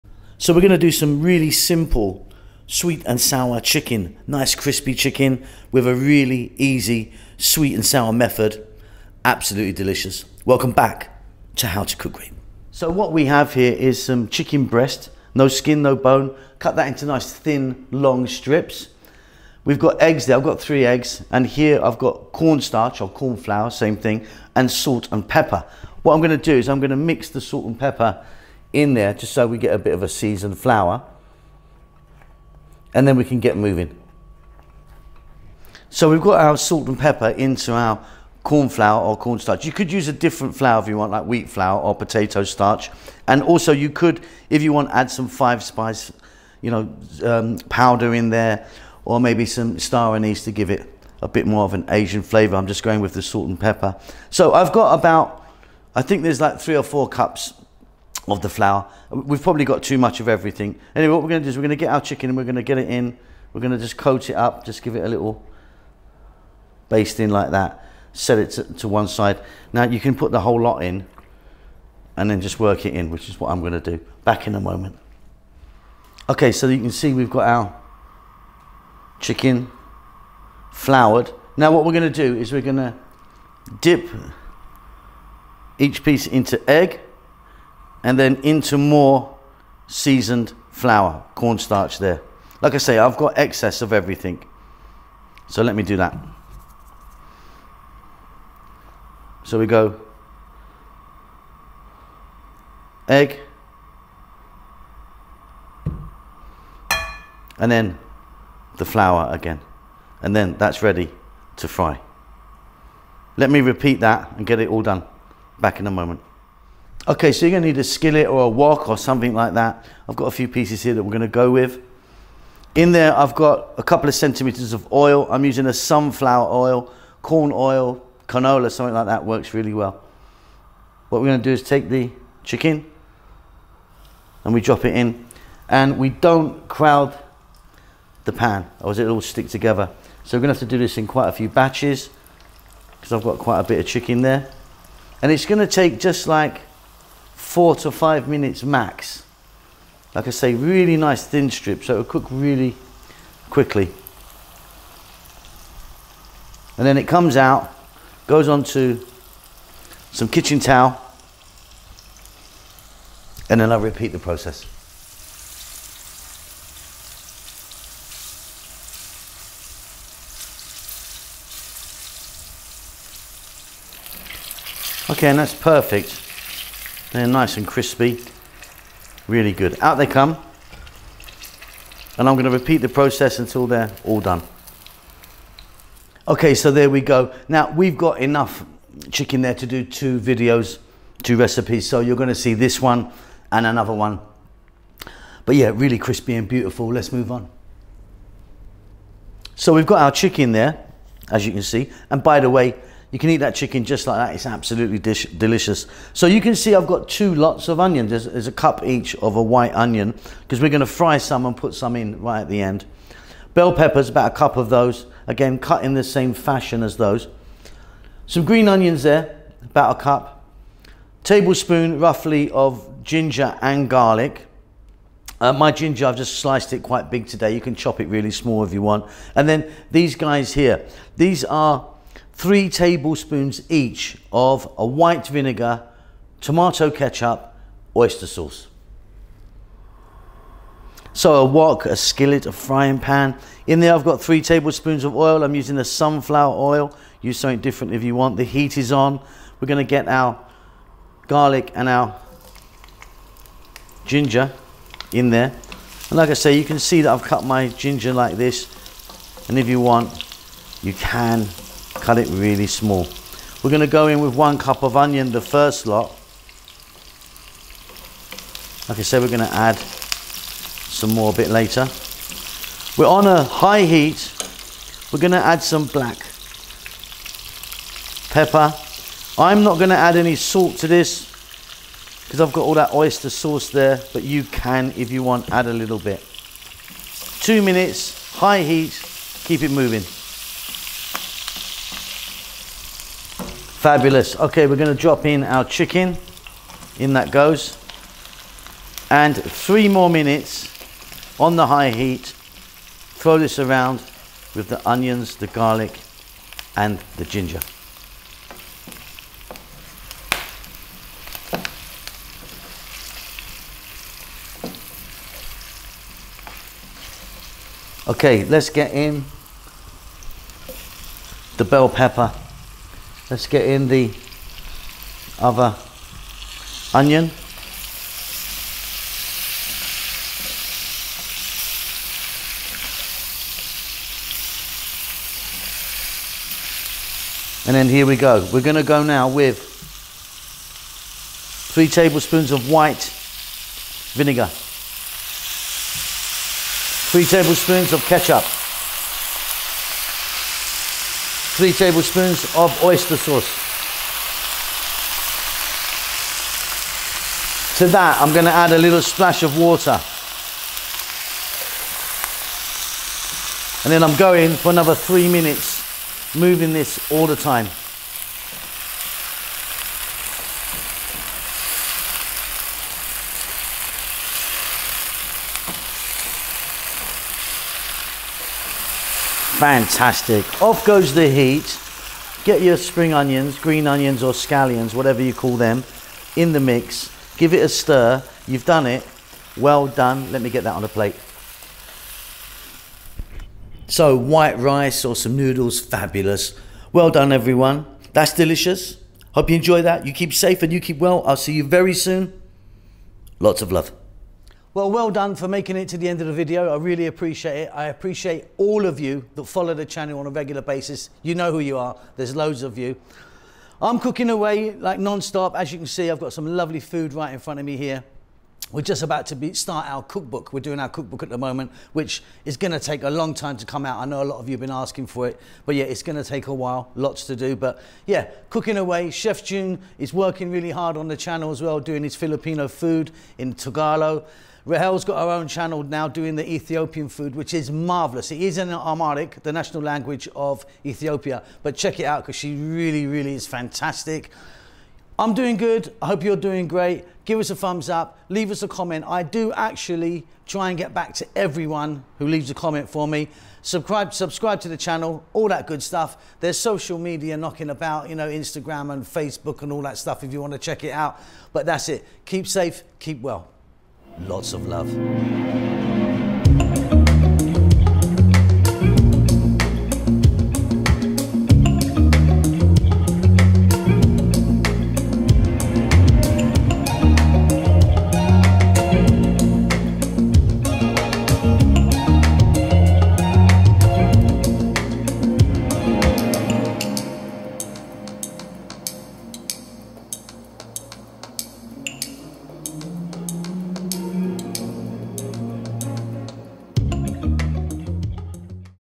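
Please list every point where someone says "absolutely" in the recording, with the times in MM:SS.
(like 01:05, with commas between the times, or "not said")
00:09, 03:24.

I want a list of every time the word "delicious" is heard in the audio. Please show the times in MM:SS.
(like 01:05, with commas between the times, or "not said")
00:09, 03:24, 06:38.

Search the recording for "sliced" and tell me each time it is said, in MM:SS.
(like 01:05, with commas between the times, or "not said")
03:46.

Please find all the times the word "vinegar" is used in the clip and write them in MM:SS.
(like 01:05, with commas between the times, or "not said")
03:55, 05:44.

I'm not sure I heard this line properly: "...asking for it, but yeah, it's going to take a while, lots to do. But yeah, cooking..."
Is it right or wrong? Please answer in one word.
right.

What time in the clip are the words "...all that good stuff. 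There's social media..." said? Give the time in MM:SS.
07:35.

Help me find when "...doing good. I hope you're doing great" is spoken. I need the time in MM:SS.
07:25.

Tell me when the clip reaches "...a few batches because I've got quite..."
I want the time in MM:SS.
02:21.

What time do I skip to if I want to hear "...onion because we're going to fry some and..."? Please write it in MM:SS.
03:29.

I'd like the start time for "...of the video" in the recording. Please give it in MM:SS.
06:46.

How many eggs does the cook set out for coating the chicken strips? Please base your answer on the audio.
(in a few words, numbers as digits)
3.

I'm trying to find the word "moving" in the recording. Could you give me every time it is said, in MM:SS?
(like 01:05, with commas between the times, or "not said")
00:33, 04:49, 06:06.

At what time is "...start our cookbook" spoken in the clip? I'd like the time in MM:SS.
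06:59.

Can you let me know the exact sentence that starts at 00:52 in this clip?
I'm just going with the salt and pepper.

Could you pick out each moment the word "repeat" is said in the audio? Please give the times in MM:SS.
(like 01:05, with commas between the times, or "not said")
01:53, 02:43, 03:02.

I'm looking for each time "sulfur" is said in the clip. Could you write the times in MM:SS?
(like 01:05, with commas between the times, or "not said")
not said.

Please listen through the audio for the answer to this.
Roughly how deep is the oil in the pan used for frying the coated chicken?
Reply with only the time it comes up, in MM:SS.
02:03.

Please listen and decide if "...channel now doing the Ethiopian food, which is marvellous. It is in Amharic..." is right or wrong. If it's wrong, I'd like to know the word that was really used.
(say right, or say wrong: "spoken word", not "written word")
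right.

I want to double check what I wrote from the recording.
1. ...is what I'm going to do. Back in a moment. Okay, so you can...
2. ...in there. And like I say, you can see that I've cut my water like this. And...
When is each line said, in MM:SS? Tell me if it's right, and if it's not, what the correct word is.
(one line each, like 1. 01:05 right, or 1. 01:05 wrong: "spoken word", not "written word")
1. 01:13 right
2. 04:15 wrong: "ginger", not "water".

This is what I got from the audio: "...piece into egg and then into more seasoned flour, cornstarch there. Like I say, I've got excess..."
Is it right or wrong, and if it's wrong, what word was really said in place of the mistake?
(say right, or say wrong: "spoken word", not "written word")
right.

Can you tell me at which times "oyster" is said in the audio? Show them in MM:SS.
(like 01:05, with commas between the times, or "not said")
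03:57, 04:42, 05:52.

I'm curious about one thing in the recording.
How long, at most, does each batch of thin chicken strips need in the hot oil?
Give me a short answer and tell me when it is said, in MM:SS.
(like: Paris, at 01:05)
4 to 5 minutes, at 02:27.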